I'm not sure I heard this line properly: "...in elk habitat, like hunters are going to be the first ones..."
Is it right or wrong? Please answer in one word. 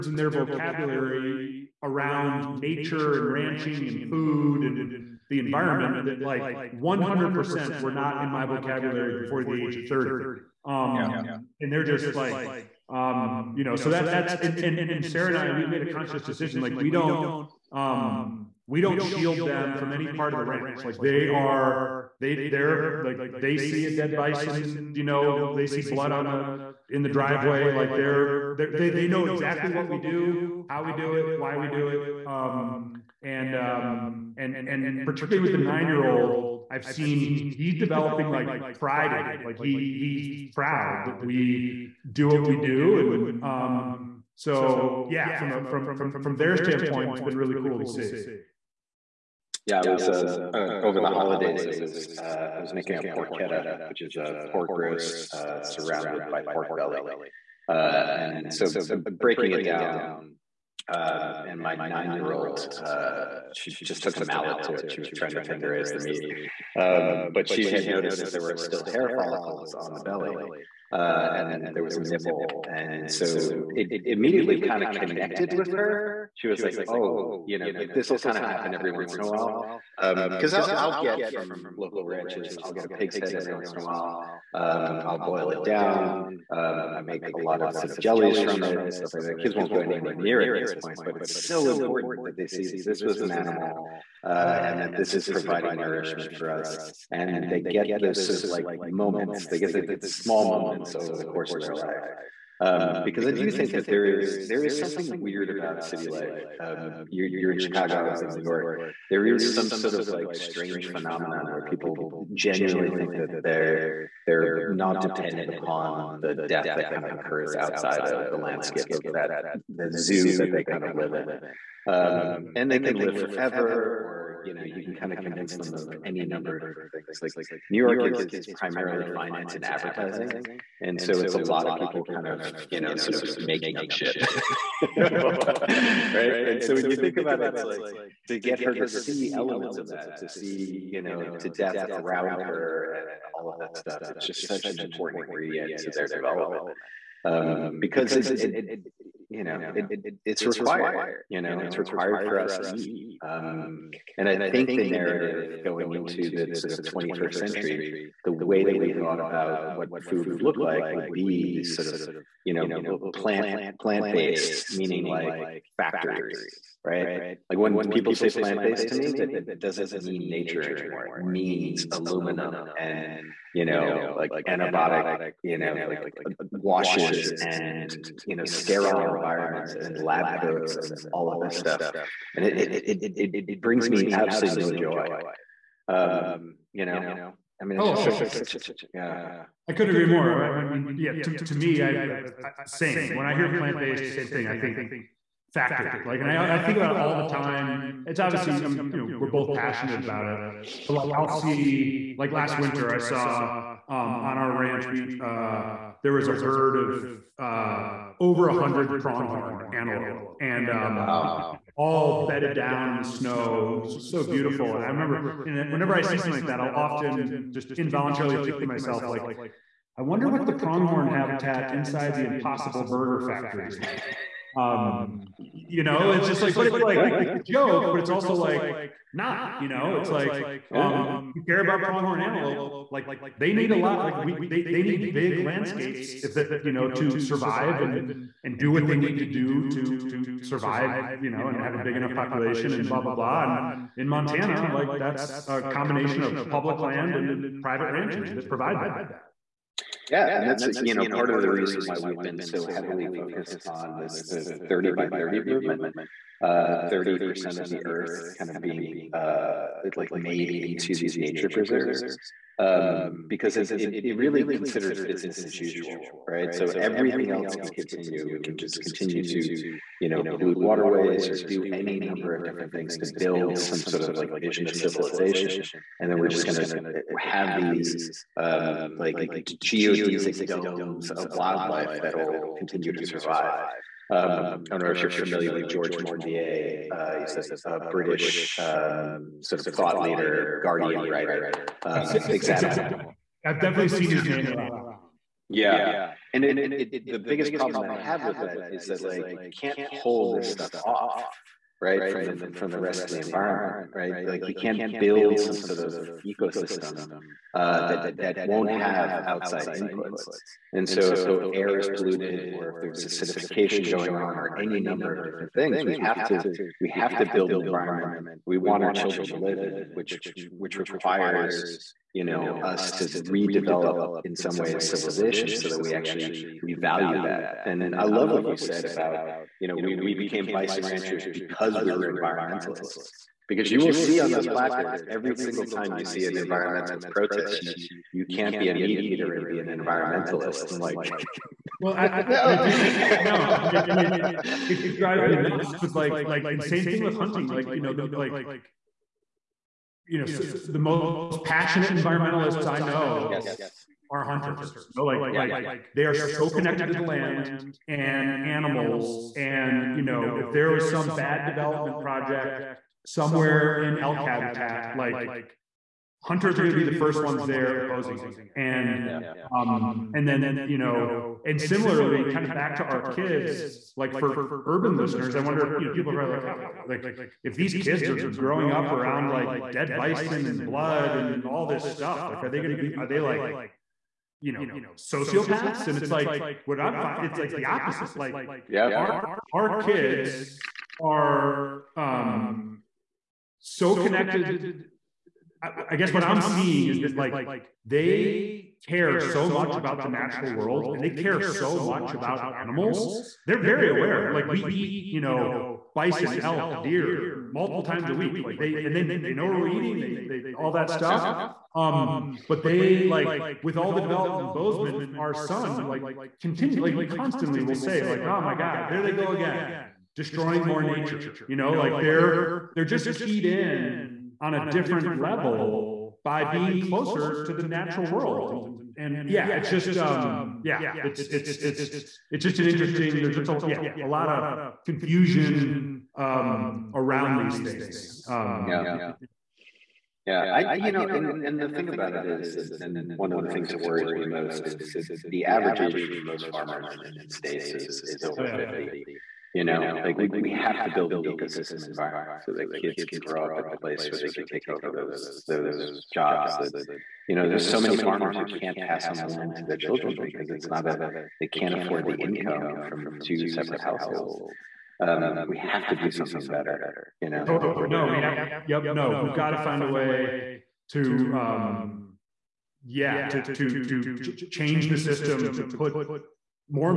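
right.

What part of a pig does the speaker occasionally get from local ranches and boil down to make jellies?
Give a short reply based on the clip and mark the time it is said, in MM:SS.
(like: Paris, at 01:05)
Pig's head, at 01:22.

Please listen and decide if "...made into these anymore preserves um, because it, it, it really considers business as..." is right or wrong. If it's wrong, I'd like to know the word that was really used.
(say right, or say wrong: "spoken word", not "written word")
wrong: "nature", not "anymore".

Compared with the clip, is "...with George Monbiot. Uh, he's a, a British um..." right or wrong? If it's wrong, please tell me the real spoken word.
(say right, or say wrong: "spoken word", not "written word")
right.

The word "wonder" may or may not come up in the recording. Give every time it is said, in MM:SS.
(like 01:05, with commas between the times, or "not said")
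03:40, 06:15.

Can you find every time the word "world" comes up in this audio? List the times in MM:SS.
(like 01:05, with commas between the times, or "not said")
06:40, 07:08.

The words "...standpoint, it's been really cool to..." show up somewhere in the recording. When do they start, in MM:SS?
00:46.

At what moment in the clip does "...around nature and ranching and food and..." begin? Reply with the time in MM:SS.
00:01.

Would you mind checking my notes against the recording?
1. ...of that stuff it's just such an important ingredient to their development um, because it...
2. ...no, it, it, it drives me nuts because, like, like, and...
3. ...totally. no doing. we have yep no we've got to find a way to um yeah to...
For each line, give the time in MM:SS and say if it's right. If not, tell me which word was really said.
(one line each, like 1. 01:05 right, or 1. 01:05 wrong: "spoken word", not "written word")
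1. 02:23 right
2. 05:43 right
3. 07:47 right.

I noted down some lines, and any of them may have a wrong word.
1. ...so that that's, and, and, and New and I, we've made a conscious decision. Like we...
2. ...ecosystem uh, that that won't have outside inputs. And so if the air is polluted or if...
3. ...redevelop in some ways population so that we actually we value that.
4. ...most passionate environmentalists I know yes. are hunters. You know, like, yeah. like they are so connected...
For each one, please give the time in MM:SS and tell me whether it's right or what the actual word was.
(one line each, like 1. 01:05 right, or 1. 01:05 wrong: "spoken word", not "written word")
1. 00:13 wrong: "Sarah", not "New"
2. 05:06 right
3. 05:23 wrong: "civilization", not "population"
4. 05:50 right.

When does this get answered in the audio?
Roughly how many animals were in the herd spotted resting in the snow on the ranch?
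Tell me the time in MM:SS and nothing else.
03:28.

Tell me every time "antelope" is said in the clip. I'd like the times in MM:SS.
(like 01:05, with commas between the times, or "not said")
03:29, 03:52.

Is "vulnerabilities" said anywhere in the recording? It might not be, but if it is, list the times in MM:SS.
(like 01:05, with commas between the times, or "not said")
not said.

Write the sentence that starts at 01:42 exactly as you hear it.
Um, because I do think that there is there is something weird about city life.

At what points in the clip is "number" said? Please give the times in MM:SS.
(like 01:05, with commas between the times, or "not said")
02:06, 04:31, 05:14.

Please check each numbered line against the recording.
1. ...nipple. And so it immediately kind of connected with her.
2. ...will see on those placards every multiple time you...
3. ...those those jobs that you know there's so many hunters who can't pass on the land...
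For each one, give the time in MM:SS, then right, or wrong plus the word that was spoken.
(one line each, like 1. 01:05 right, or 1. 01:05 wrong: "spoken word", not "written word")
1. 01:12 right
2. 05:33 wrong: "single", not "multiple"
3. 07:34 wrong: "farmers", not "hunters".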